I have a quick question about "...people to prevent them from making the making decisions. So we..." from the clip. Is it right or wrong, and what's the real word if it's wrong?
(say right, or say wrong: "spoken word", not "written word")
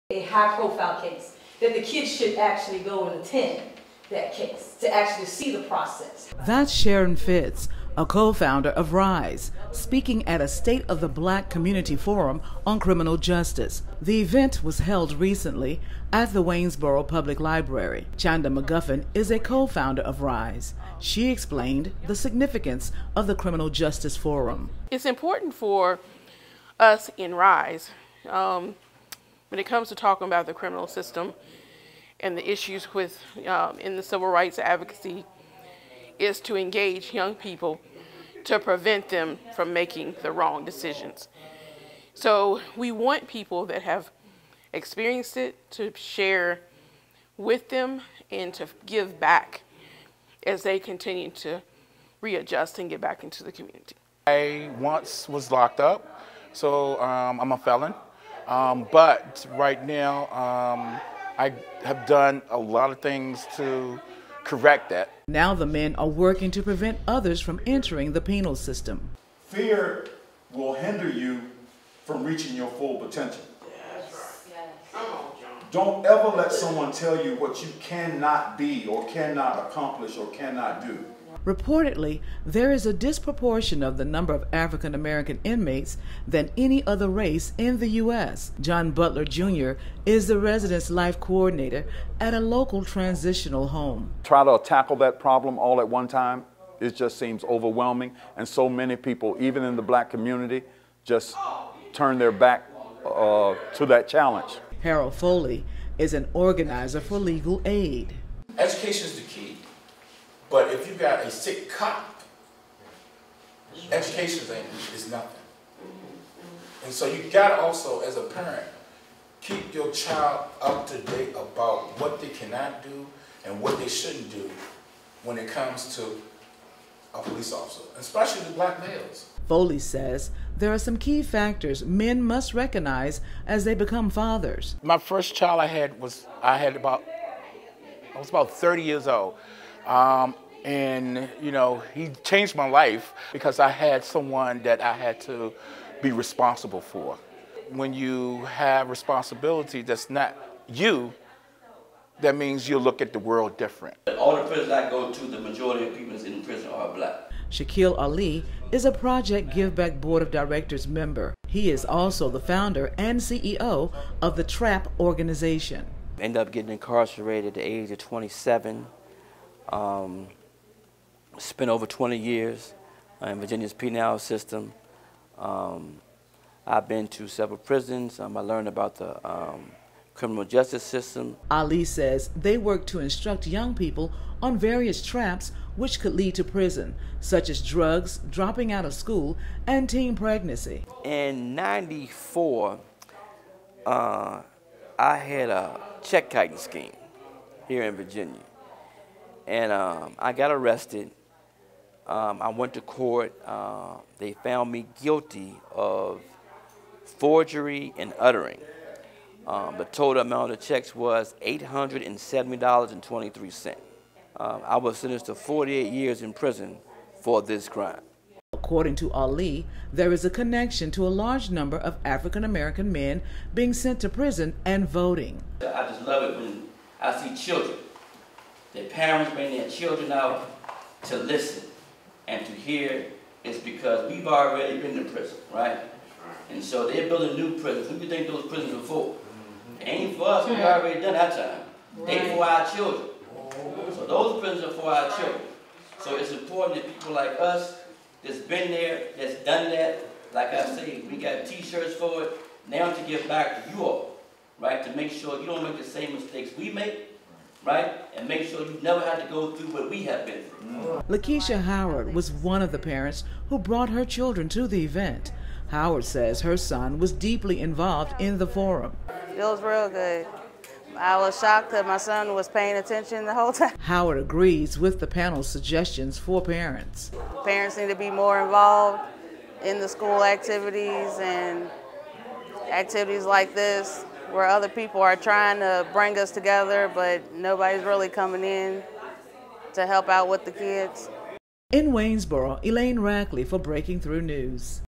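wrong: "wrong", not "making".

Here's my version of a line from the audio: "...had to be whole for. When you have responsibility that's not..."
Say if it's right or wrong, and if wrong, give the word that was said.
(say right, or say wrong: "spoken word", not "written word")
wrong: "responsible", not "whole".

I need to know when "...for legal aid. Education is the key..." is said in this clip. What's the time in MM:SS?
01:46.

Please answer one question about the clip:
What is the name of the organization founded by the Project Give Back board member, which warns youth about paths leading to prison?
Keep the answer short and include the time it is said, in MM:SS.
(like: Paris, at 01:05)
TRAP, at 02:44.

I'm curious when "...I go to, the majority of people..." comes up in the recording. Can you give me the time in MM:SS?
02:34.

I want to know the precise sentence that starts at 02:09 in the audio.
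Foley says there are some key factors men must recognize as they become fathers.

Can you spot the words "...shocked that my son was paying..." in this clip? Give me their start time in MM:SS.
04:31.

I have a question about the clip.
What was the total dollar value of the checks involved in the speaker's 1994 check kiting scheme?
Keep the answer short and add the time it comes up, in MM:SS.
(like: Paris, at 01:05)
$870.23, at 03:31.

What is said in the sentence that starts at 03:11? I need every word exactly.
In 94, uh, I had a check kiting scheme here in Virginia.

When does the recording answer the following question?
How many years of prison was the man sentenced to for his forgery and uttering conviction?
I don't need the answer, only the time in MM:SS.
03:35.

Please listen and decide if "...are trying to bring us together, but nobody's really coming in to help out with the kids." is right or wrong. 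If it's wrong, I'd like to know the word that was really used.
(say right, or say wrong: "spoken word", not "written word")
right.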